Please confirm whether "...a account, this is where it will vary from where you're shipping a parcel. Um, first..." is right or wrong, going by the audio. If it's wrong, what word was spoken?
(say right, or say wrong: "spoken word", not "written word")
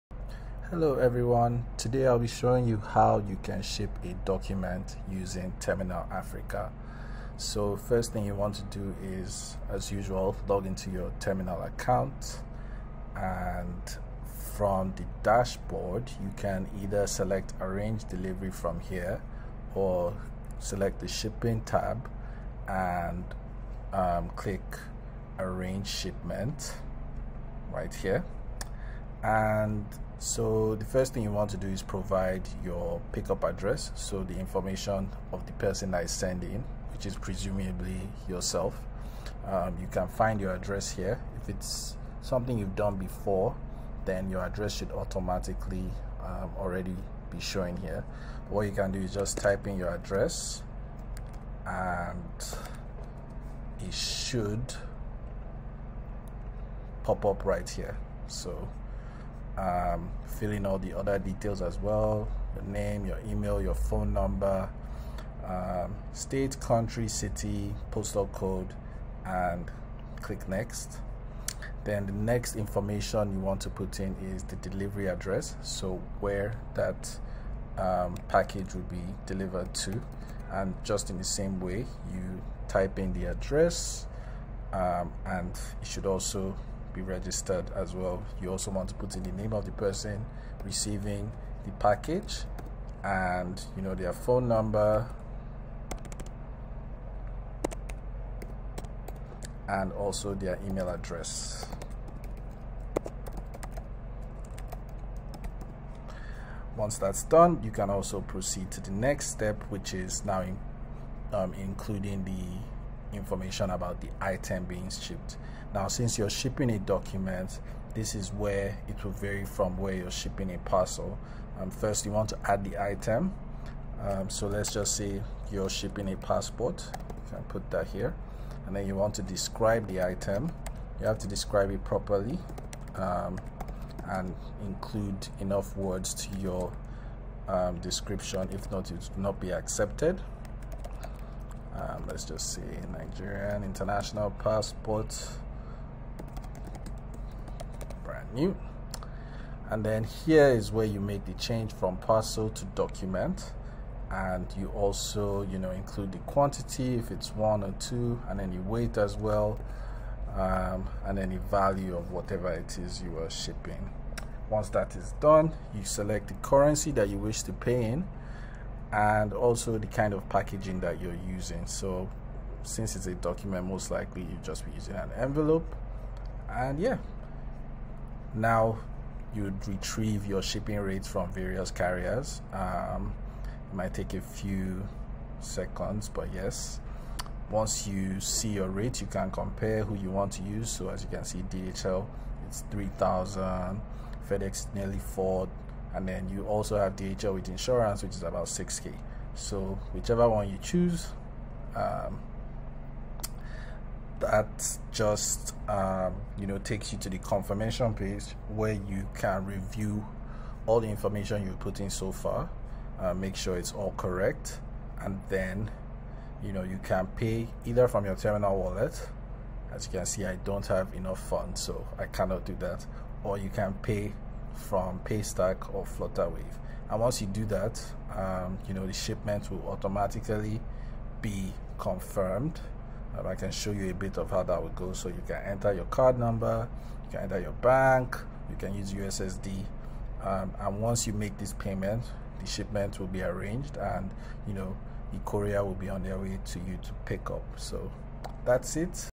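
wrong: "document", not "account".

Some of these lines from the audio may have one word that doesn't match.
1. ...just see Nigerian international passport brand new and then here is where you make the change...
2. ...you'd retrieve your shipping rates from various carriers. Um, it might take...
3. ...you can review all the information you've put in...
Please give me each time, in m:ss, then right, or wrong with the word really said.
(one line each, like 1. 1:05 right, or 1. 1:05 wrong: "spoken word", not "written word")
1. 2:22 right
2. 2:59 right
3. 3:28 right.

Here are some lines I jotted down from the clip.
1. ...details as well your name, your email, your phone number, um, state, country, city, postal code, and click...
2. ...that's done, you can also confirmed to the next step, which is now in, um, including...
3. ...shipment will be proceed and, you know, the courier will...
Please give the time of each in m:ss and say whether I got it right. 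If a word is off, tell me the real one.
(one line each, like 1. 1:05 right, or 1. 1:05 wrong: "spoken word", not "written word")
1. 1:01 right
2. 1:46 wrong: "proceed", not "confirmed"
3. 4:02 wrong: "arranged", not "proceed".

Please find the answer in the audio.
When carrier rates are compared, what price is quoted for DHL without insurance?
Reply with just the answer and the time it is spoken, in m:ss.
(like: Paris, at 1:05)
3,000, at 3:12.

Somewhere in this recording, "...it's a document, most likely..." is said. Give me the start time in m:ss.
2:52.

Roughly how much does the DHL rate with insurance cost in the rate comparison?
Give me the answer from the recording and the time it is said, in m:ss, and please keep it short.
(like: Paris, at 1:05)
6k, at 3:18.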